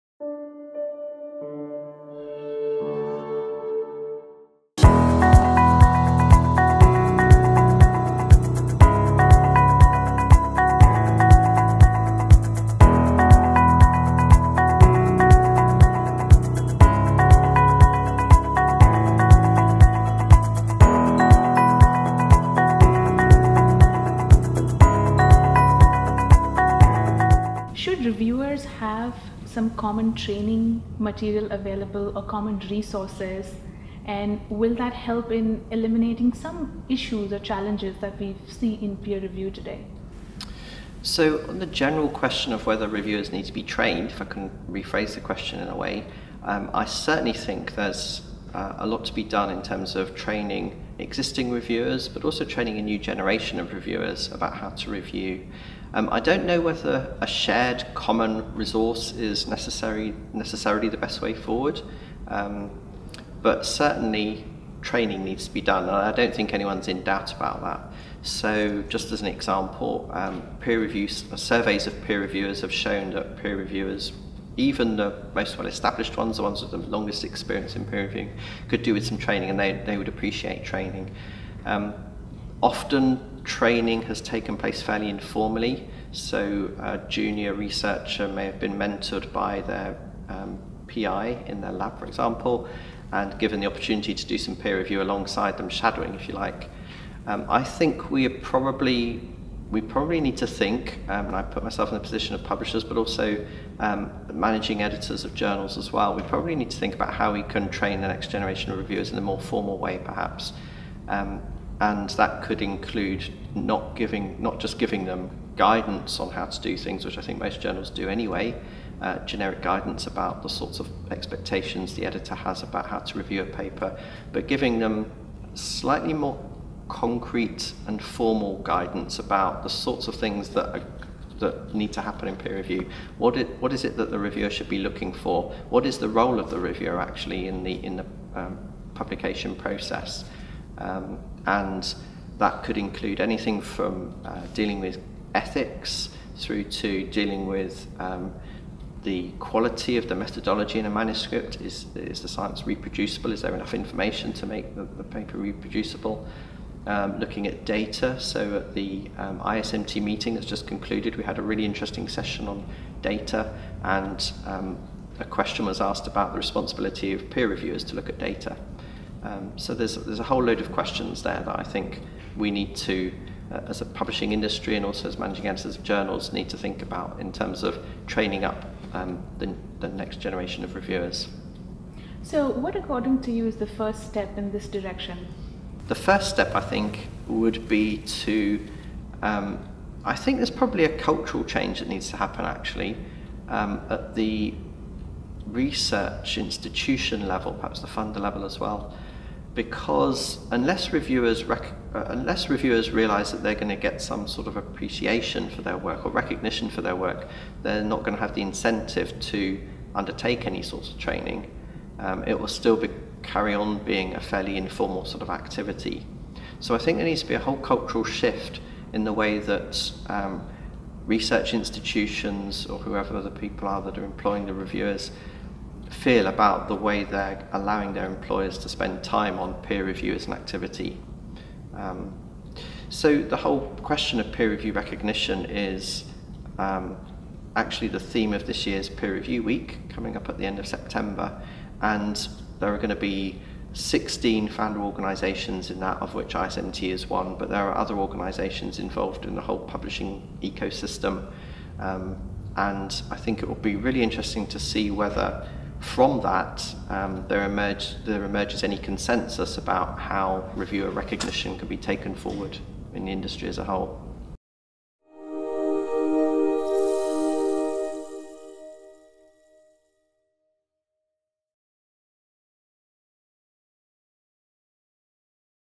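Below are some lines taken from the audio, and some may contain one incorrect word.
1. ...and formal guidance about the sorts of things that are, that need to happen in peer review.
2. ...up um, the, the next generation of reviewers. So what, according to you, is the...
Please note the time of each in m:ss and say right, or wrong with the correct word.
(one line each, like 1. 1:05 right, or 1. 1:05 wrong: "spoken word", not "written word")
1. 2:07 right
2. 2:58 right.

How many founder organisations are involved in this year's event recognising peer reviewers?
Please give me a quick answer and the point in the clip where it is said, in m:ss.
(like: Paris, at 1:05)
16, at 4:03.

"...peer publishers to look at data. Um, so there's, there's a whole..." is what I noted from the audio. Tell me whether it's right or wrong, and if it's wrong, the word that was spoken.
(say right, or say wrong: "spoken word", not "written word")
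wrong: "reviewers", not "publishers".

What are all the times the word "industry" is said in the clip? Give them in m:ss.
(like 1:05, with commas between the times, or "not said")
2:54, 4:23.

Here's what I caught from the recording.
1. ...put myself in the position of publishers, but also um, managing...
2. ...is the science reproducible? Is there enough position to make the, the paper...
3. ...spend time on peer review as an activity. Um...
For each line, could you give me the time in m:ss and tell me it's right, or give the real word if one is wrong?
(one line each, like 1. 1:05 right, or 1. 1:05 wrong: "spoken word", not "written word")
1. 1:41 right
2. 2:31 wrong: "information", not "position"
3. 3:48 right.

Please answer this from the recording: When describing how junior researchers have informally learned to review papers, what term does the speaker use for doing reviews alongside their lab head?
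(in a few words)
Shadowing.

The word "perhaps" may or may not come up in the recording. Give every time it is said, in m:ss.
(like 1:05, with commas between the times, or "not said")
1:50, 3:17.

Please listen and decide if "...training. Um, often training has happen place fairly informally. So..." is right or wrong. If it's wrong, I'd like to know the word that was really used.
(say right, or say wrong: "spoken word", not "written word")
wrong: "taken", not "happen".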